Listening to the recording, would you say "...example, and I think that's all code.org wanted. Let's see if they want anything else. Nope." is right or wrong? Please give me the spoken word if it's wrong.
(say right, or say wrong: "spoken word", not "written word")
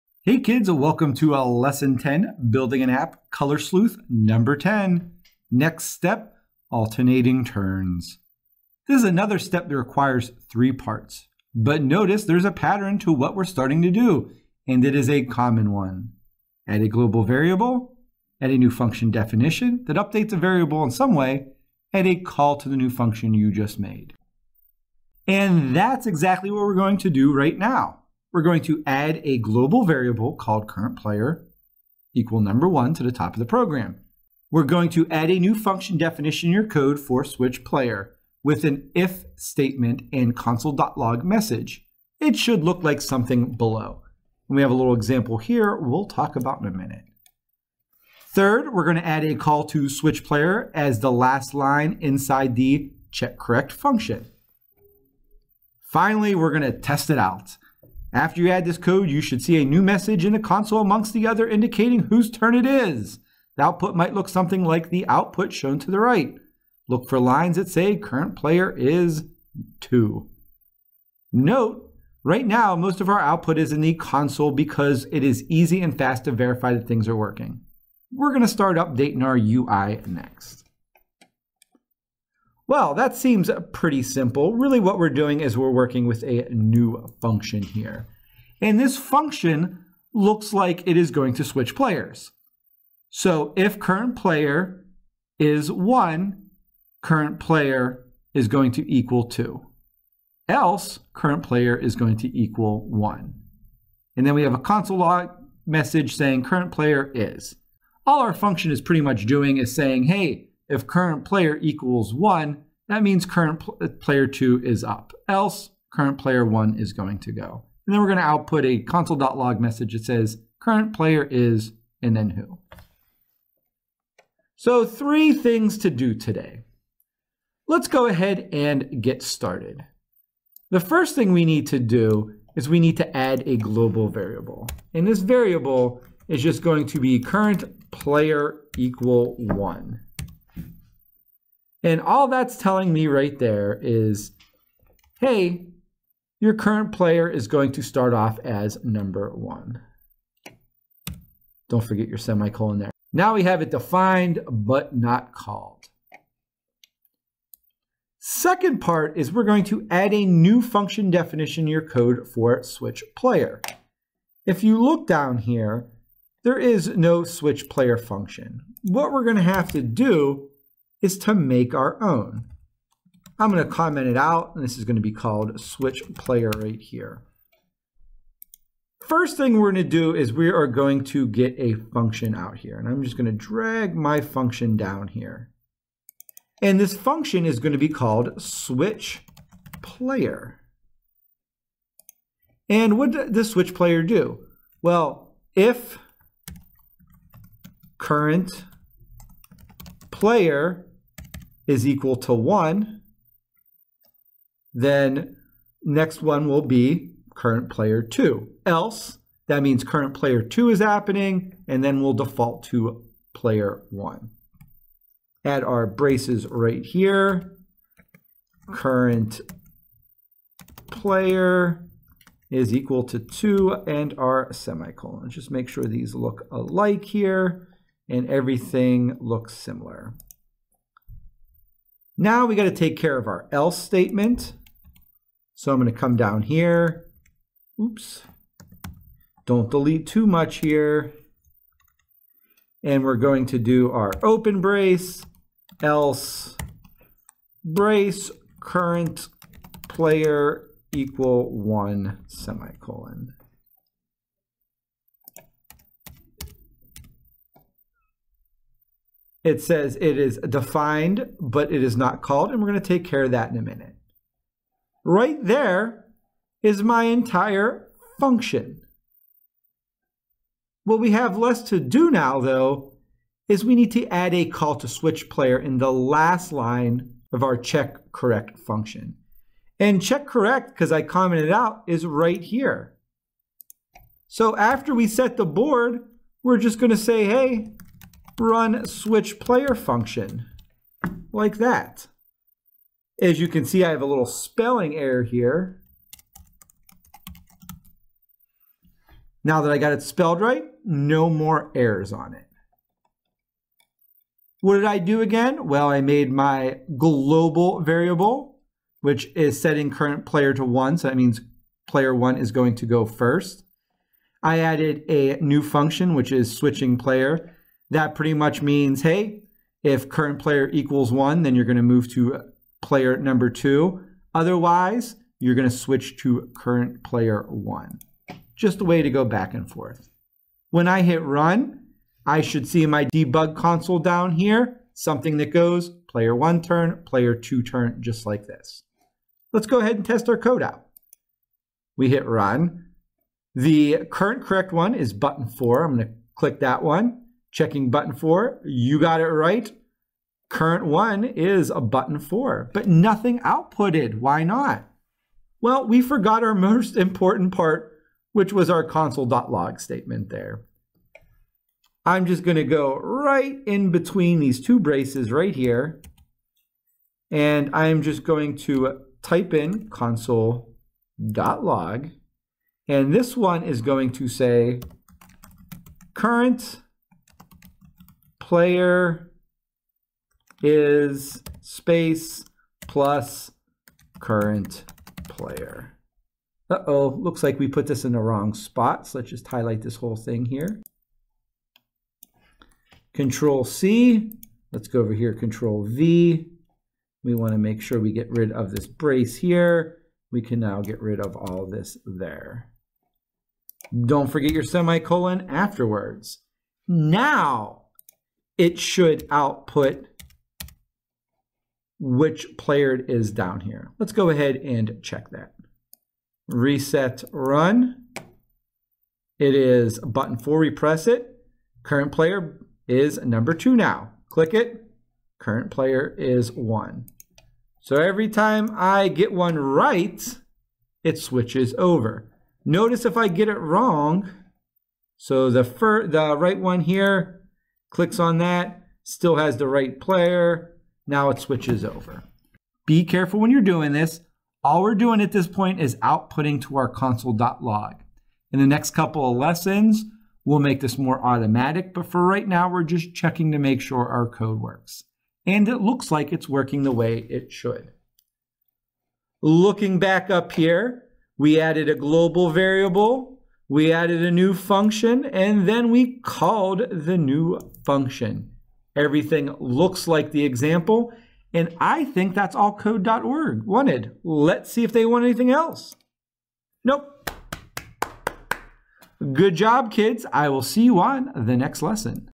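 right.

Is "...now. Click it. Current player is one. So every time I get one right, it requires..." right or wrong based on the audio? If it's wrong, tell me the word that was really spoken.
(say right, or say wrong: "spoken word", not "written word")
wrong: "switches", not "requires".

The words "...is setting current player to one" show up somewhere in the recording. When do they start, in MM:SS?
05:09.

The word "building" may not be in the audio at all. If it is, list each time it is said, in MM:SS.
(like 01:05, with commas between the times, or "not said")
00:02.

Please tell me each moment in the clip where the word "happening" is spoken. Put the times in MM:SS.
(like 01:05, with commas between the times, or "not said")
03:30.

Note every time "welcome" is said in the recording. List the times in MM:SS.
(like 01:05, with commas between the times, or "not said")
00:00.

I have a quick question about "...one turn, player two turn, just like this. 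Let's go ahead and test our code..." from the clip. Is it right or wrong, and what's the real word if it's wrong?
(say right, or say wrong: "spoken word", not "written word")
right.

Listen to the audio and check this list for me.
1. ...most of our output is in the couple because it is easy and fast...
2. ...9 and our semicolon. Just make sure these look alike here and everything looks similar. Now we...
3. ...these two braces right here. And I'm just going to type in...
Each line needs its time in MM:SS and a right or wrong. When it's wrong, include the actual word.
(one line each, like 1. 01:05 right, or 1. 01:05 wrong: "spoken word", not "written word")
1. 01:12 wrong: "console", not "couple"
2. 03:43 wrong: "2", not "9"
3. 06:04 right.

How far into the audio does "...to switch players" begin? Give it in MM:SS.
01:31.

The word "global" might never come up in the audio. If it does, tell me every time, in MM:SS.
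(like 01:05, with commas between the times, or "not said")
00:16, 00:29, 02:13, 05:06, 07:41.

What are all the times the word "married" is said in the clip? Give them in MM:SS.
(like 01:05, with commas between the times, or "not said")
not said.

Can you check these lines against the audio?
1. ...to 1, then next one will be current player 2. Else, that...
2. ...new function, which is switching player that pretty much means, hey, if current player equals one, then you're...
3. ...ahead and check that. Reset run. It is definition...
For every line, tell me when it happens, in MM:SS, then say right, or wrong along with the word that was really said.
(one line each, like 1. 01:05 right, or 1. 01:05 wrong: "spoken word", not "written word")
1. 03:22 right
2. 05:15 right
3. 06:54 wrong: "button", not "definition".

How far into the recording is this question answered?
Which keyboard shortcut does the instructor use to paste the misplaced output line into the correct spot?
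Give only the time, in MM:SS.
06:35.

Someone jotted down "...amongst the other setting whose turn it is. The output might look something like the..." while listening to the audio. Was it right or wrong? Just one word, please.
wrong.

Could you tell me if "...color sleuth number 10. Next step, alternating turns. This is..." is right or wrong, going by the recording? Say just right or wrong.
right.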